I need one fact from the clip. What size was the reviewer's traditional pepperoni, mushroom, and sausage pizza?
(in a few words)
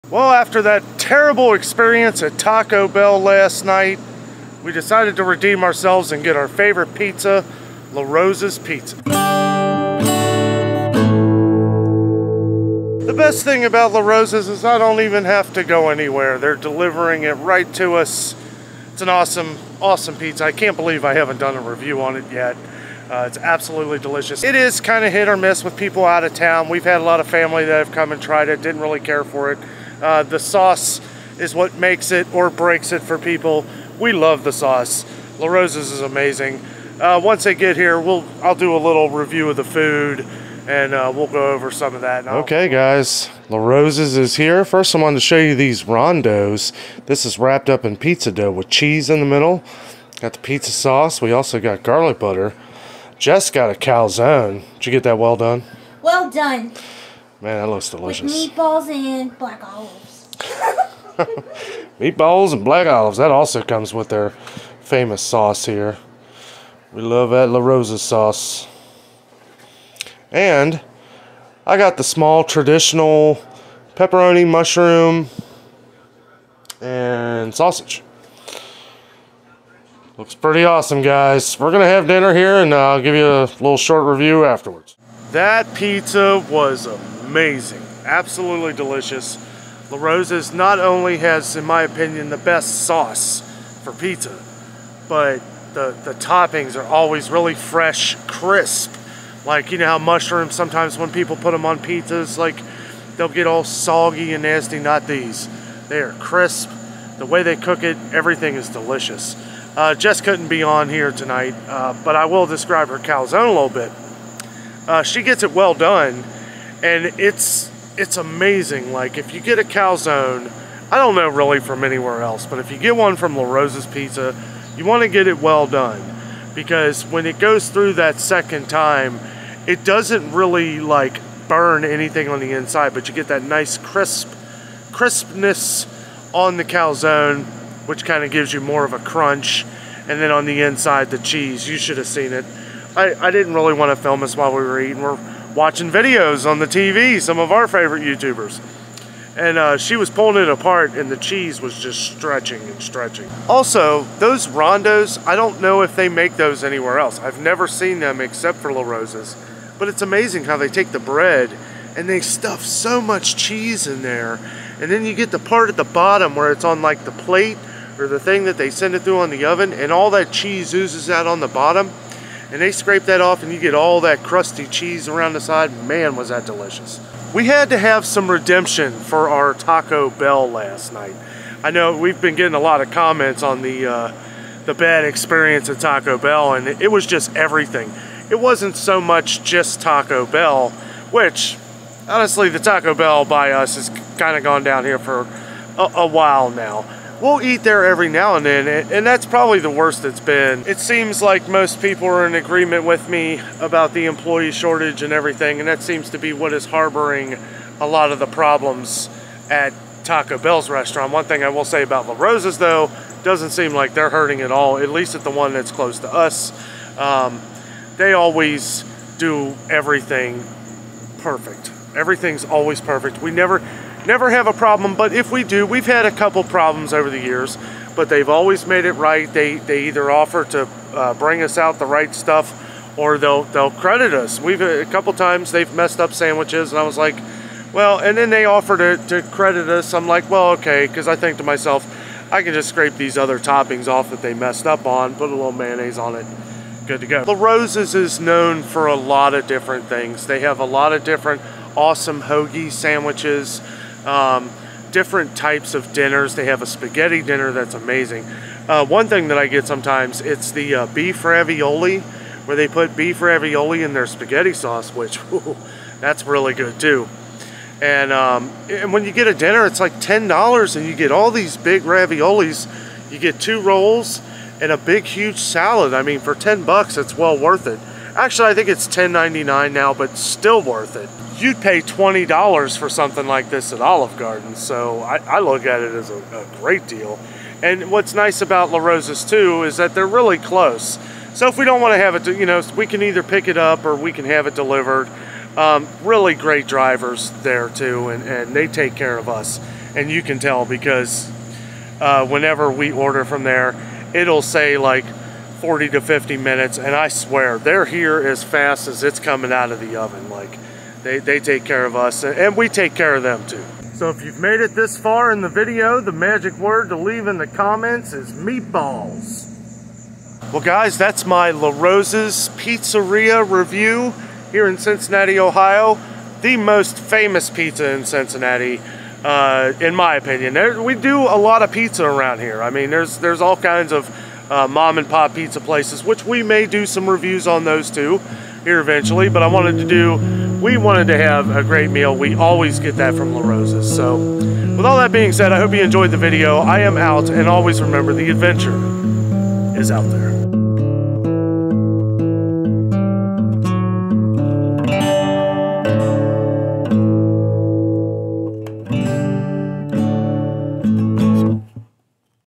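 small.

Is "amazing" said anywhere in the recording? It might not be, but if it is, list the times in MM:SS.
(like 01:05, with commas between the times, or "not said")
00:36, 01:27, 01:58, 02:40, 04:17.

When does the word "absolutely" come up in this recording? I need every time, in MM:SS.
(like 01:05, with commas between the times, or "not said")
00:23, 01:28.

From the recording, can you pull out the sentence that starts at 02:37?
I've never seen them except for LaRosa's.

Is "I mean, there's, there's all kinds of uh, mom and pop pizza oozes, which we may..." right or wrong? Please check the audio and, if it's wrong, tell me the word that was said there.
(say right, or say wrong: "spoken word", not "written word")
wrong: "places", not "oozes".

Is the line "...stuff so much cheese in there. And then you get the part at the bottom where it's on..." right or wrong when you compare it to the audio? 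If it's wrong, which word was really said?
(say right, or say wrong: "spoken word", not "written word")
right.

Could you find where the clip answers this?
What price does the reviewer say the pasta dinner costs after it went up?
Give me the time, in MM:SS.
04:38.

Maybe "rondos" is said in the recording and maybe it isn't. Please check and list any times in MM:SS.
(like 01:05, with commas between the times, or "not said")
00:45, 02:34.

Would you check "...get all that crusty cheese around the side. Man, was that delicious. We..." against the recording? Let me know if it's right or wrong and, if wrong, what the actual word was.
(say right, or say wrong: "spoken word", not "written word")
right.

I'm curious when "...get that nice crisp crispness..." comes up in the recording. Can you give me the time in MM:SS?
02:13.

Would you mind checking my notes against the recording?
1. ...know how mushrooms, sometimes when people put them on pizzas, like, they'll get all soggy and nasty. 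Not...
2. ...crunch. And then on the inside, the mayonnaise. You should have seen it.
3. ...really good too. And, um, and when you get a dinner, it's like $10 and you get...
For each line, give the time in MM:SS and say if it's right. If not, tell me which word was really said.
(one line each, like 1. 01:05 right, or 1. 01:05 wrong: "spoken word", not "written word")
1. 01:39 right
2. 02:18 wrong: "cheese", not "mayonnaise"
3. 04:26 right.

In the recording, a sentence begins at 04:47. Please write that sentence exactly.
And what's nice about LaRosa's too is that they're really close.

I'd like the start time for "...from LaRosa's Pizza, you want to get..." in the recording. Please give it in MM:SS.
02:03.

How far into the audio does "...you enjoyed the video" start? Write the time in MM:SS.
05:45.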